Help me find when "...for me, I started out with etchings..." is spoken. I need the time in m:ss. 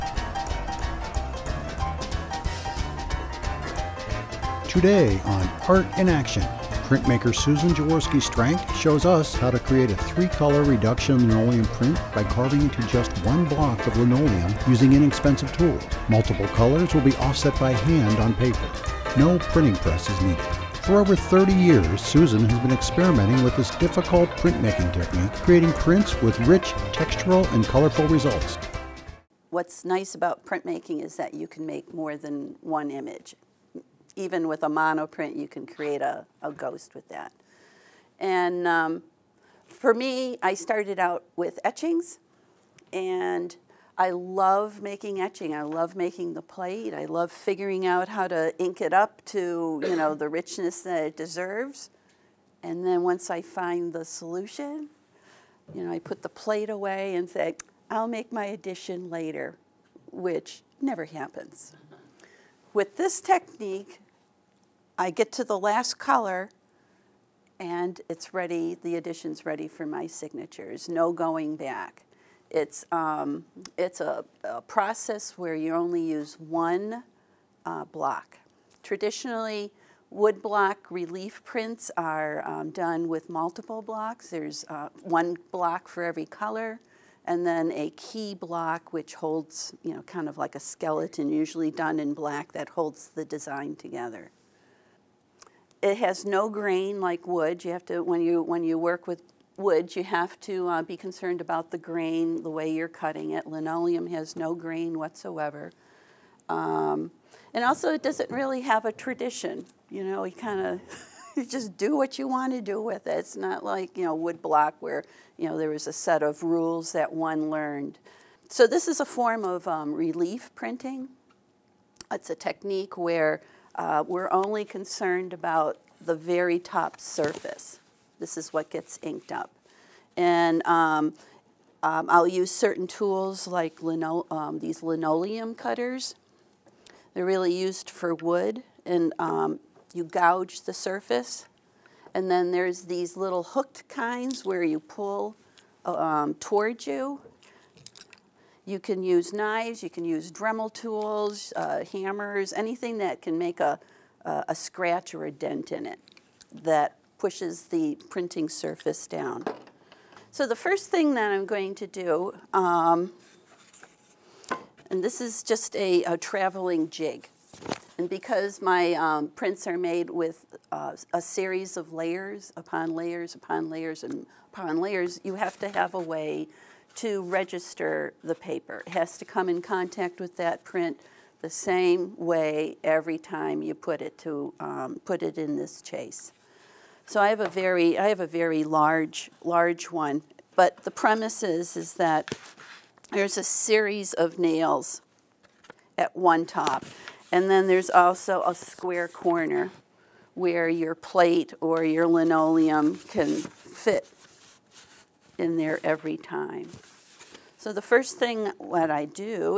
0:39.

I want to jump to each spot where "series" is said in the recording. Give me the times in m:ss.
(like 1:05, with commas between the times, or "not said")
2:51, 3:13.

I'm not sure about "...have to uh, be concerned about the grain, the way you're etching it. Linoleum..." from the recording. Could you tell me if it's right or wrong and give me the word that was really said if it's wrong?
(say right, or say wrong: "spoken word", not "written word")
wrong: "cutting", not "etching".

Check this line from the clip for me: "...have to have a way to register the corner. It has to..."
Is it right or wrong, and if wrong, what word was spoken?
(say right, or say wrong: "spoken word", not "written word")
wrong: "paper", not "corner".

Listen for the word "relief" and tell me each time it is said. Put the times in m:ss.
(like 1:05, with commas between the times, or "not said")
1:20, 1:59.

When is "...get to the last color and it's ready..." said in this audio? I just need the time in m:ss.
1:05.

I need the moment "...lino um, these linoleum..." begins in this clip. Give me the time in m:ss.
2:13.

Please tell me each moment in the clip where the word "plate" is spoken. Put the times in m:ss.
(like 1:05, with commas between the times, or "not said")
0:46, 0:56, 3:20.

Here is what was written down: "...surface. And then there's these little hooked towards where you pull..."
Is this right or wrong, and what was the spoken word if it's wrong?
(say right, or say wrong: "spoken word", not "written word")
wrong: "kinds", not "towards".